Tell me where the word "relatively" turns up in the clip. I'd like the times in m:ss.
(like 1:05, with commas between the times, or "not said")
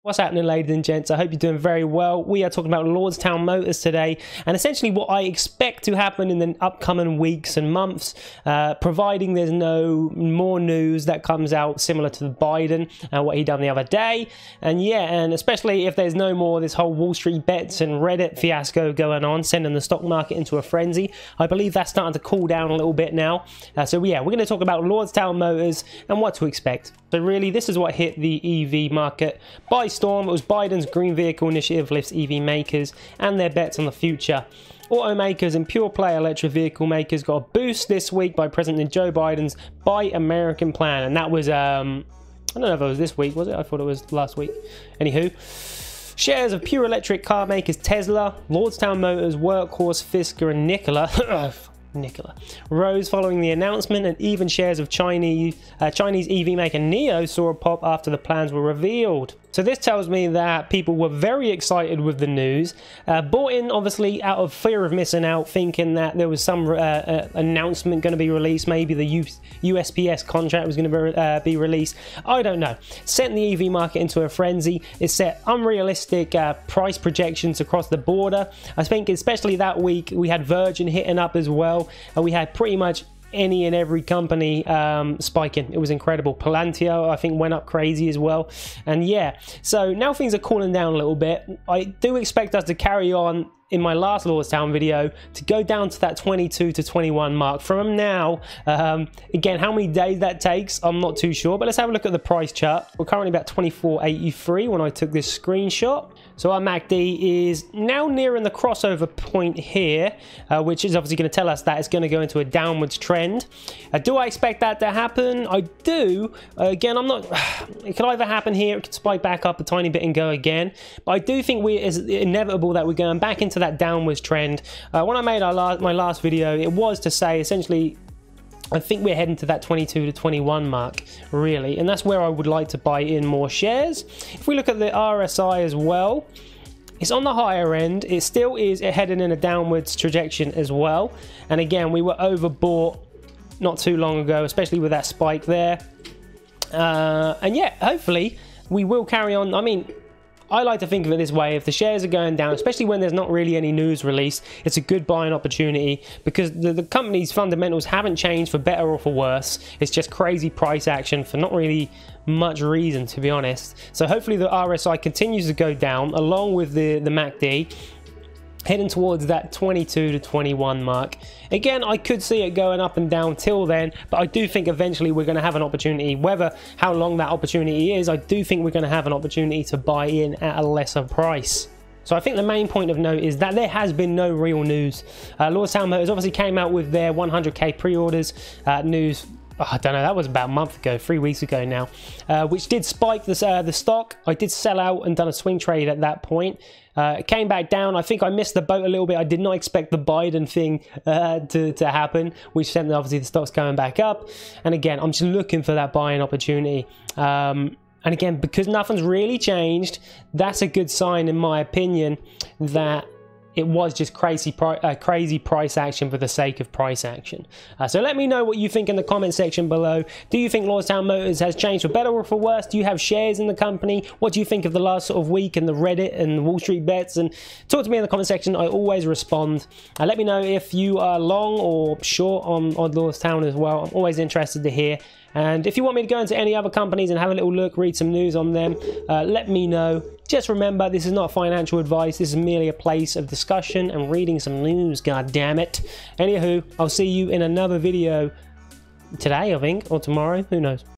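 not said.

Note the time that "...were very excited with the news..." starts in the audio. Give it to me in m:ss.
1:00.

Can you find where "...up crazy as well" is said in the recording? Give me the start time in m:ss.
1:27.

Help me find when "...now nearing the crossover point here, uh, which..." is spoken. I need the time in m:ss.
1:47.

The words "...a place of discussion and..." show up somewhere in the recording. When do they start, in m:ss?
4:02.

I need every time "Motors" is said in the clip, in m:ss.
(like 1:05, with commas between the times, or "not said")
0:03, 0:25, 0:48, 3:41.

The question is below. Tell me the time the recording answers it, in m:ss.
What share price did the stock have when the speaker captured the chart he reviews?
1:43.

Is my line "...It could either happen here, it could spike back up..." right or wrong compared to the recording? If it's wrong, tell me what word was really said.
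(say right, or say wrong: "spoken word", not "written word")
right.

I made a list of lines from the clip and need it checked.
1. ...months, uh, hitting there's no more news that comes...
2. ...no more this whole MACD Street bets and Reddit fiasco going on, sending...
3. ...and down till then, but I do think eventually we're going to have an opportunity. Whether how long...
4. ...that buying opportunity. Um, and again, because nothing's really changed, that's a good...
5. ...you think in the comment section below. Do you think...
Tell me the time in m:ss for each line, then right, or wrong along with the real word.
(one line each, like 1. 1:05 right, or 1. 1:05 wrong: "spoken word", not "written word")
1. 0:07 wrong: "providing", not "hitting"
2. 0:16 wrong: "Wall", not "MACD"
3. 2:52 right
4. 3:25 right
5. 3:38 right.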